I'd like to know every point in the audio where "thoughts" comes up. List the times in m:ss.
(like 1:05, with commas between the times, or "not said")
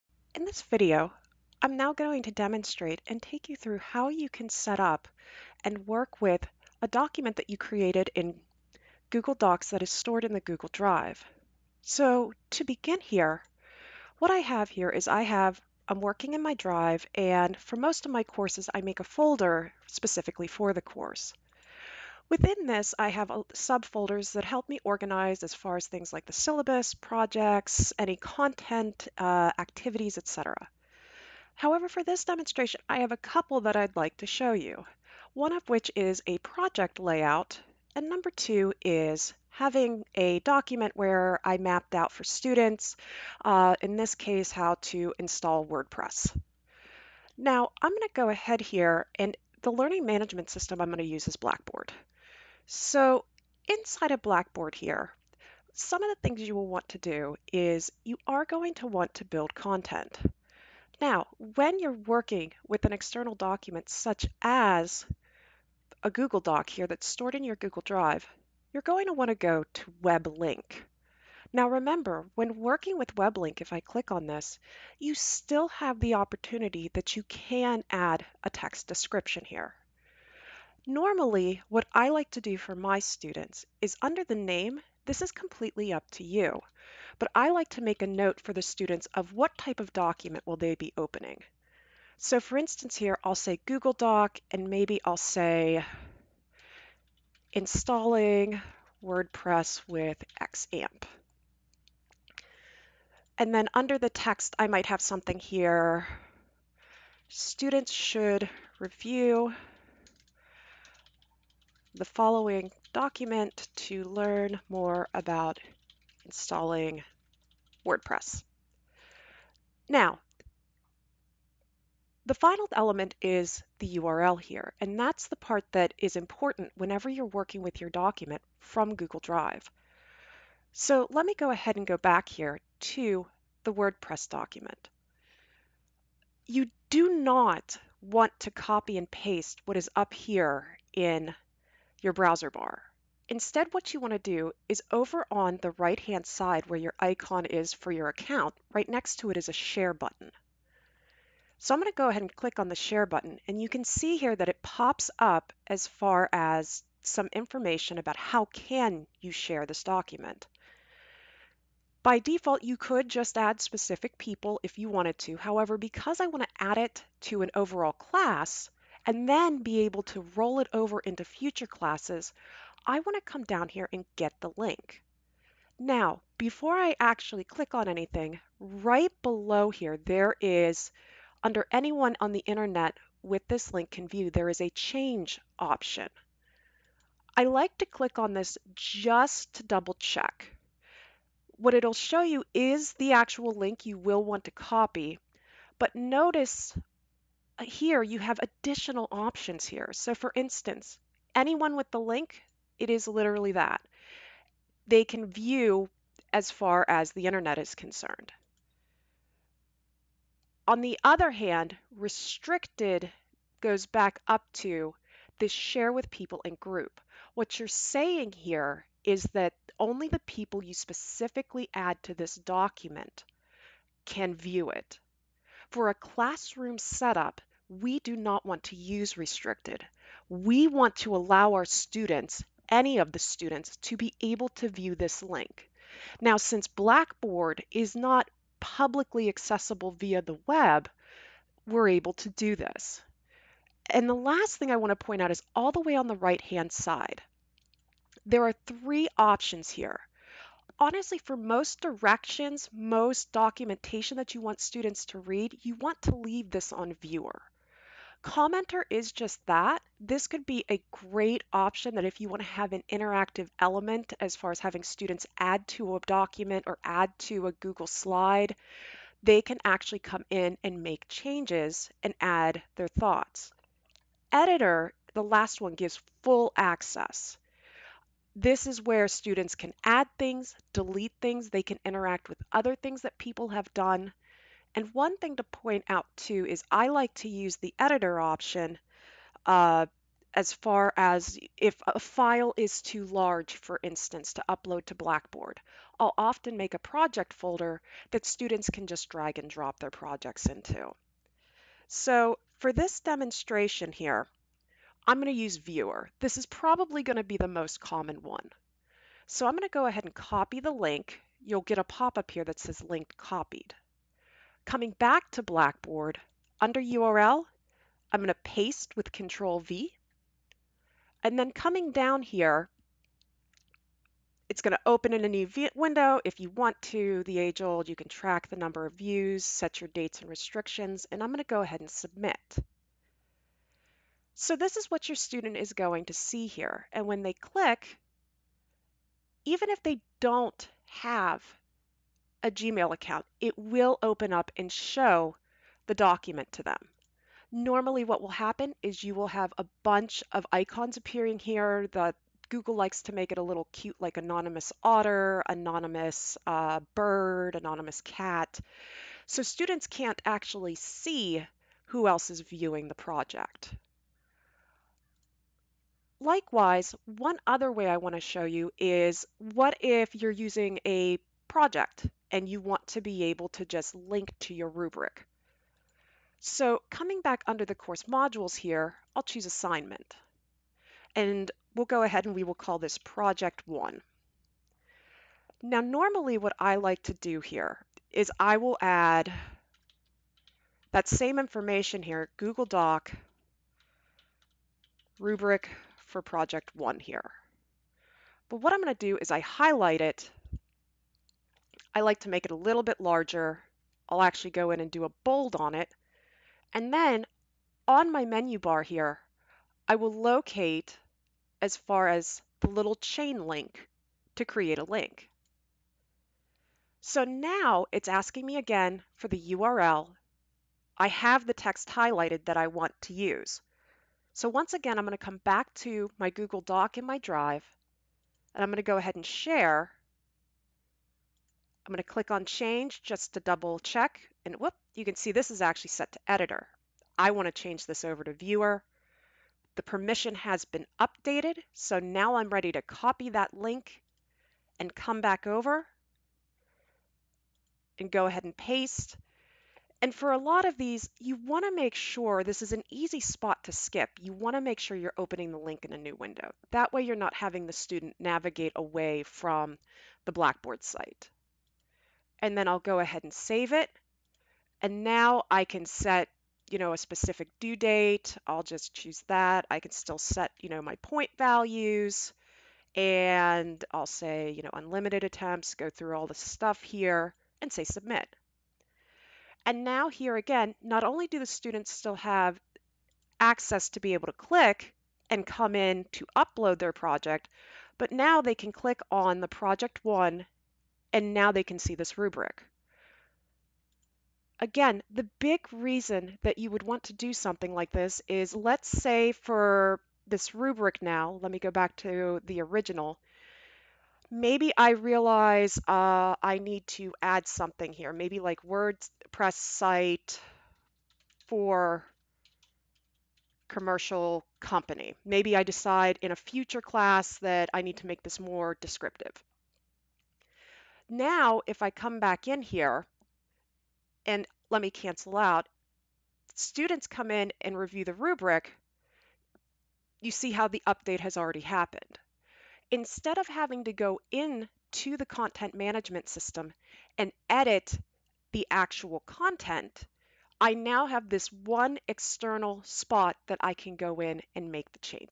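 4:32.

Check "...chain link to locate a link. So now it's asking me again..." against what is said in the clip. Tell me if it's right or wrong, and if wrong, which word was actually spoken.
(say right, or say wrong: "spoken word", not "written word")
wrong: "create", not "locate".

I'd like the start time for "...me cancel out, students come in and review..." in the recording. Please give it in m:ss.
8:44.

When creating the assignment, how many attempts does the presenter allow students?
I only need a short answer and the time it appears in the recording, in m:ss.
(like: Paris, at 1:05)
unlimited, at 7:54.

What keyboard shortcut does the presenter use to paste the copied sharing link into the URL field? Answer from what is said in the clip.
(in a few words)
Control V.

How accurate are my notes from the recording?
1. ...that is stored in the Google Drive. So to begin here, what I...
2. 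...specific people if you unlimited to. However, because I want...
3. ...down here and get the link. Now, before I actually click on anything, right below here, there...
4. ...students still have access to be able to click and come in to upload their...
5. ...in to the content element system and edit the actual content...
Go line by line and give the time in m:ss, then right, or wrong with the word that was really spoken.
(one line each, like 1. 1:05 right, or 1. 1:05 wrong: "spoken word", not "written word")
1. 0:09 right
2. 2:43 wrong: "wanted", not "unlimited"
3. 2:53 right
4. 8:01 right
5. 8:54 wrong: "management", not "element".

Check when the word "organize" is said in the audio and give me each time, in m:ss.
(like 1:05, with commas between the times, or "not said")
0:24.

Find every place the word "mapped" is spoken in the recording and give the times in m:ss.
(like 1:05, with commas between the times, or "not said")
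0:41.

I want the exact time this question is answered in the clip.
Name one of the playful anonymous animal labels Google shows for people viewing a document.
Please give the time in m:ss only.
5:54.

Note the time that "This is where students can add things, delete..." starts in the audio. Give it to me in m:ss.
4:38.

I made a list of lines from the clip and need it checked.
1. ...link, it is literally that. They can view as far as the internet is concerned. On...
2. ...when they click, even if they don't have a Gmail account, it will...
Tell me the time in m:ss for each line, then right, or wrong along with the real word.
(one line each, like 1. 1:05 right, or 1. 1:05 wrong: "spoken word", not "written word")
1. 3:21 right
2. 5:37 right.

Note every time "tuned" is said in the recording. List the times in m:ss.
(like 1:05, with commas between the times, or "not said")
not said.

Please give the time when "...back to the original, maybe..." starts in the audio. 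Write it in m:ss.
8:21.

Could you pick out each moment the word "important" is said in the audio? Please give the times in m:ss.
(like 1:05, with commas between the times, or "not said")
2:06.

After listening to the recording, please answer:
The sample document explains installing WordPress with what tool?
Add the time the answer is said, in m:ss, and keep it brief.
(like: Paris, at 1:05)
XAMPP, at 1:40.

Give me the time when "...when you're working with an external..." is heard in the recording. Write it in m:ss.
1:01.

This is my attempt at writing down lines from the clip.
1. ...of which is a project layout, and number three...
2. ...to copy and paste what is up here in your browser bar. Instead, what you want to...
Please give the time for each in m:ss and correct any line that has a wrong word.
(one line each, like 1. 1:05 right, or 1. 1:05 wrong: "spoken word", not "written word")
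1. 0:35 wrong: "two", not "three"
2. 2:18 right.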